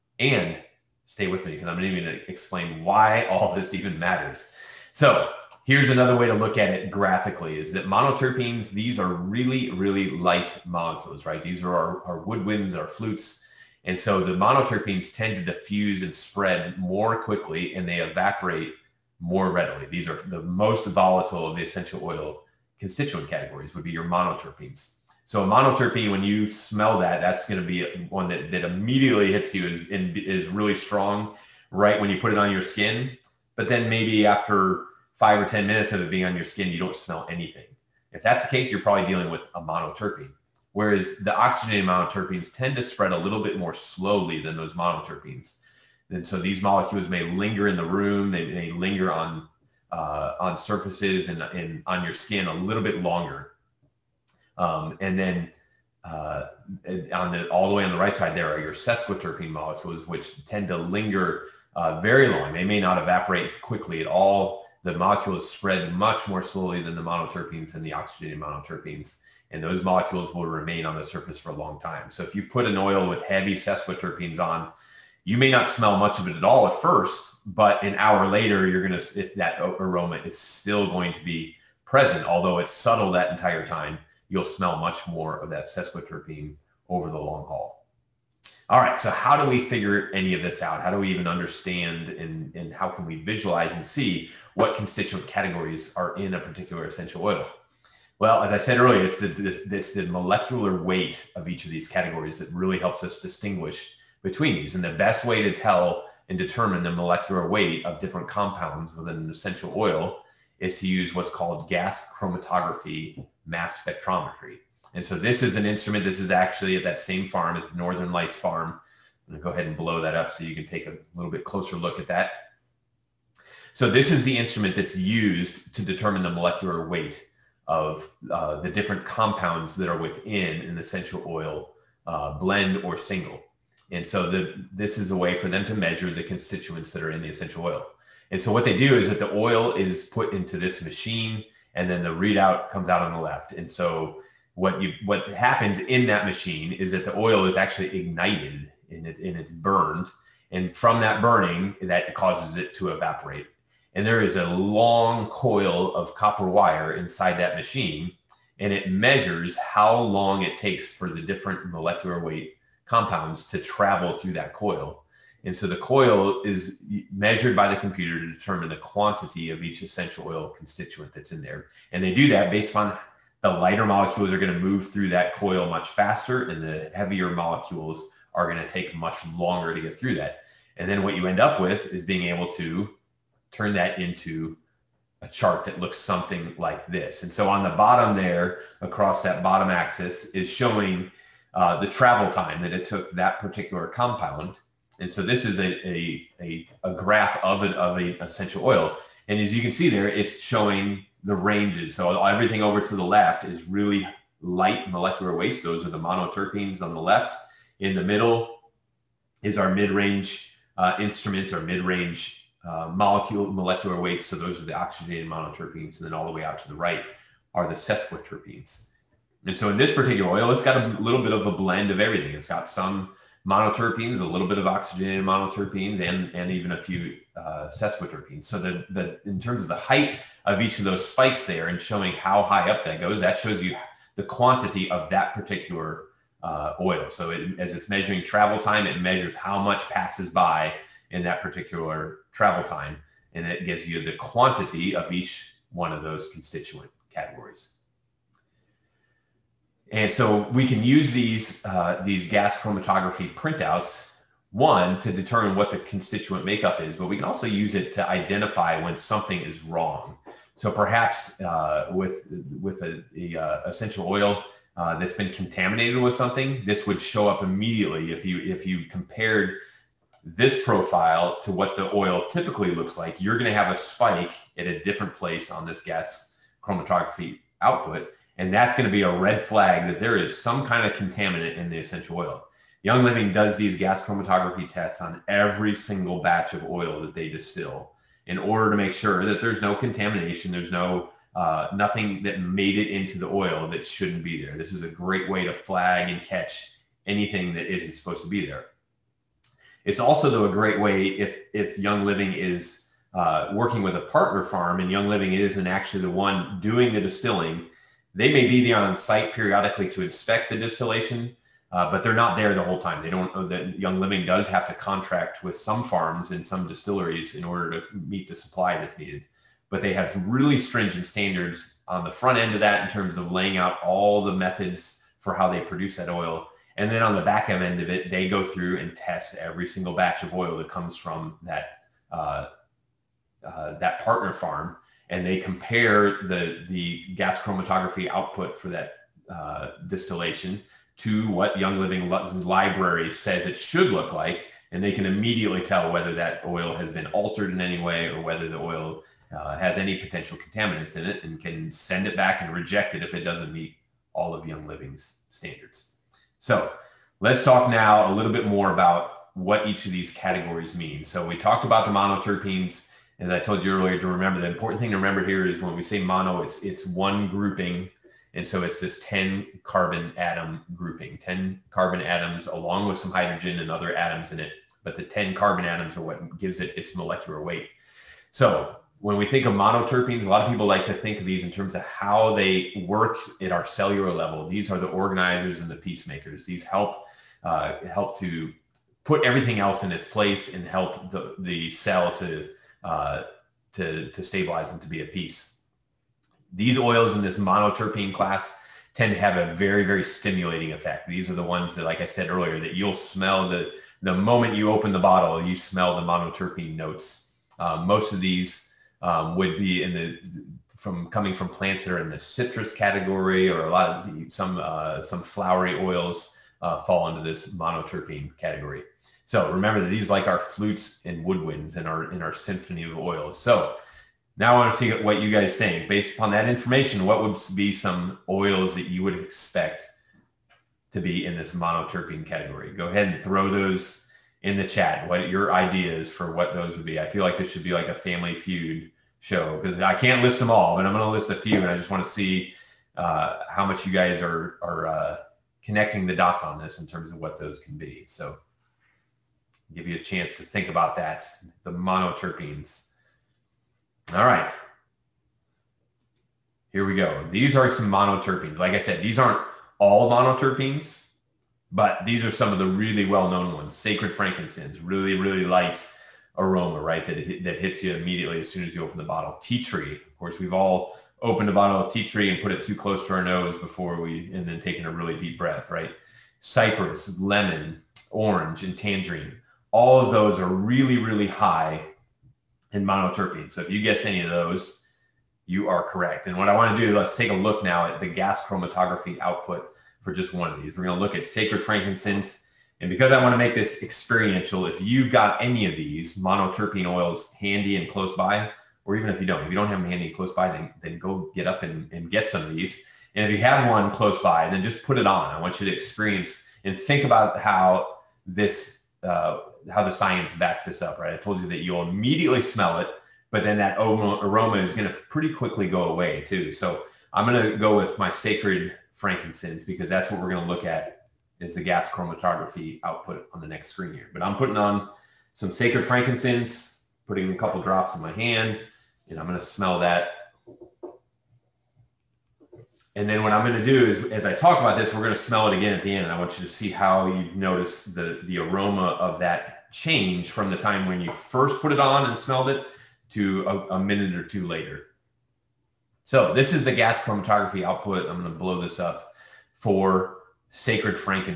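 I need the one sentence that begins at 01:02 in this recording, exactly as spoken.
They may not evaporate quickly at all.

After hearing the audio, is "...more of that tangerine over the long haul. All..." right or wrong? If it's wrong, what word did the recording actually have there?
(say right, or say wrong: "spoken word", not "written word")
wrong: "sesquiterpene", not "tangerine".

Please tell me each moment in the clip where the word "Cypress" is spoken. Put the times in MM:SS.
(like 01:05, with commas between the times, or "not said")
07:56.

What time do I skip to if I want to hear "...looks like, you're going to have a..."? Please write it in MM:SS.
04:32.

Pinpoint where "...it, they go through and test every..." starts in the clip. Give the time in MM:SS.
05:27.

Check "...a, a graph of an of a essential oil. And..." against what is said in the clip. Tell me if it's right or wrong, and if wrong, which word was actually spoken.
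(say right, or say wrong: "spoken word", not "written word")
right.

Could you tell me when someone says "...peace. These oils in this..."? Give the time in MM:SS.
06:35.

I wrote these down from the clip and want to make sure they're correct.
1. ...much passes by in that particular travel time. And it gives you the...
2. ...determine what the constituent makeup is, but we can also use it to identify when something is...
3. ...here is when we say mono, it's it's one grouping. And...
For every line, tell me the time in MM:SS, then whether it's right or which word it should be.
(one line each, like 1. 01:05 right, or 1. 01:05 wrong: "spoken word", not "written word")
1. 03:59 right
2. 04:15 right
3. 06:05 right.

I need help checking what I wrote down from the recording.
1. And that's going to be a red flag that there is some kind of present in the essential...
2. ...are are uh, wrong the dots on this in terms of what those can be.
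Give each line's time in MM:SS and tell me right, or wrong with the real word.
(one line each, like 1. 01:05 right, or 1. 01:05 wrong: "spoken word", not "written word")
1. 04:38 wrong: "contaminant", not "present"
2. 07:24 wrong: "connecting", not "wrong".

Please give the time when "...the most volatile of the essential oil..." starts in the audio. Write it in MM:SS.
00:20.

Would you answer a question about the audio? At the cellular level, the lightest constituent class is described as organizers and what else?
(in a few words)
peacemakers.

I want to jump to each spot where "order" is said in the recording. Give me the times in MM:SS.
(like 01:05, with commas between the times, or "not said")
04:48, 05:17.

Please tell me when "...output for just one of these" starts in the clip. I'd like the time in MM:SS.
08:09.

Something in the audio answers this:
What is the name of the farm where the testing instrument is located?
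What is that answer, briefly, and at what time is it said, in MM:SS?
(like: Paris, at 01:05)
Northern Lights Farm, at 01:57.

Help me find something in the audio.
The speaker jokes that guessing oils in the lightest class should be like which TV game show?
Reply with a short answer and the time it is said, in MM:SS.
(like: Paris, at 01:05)
Family Feud, at 07:17.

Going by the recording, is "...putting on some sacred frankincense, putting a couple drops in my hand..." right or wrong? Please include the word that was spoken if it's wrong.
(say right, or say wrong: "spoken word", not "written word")
right.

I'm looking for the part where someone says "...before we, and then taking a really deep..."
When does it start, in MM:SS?
07:53.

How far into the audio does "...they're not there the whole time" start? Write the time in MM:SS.
05:12.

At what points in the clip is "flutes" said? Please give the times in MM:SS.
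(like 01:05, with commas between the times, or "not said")
00:12, 07:00.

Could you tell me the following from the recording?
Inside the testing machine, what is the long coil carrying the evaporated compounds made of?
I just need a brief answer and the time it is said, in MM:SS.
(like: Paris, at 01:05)
copper, at 02:36.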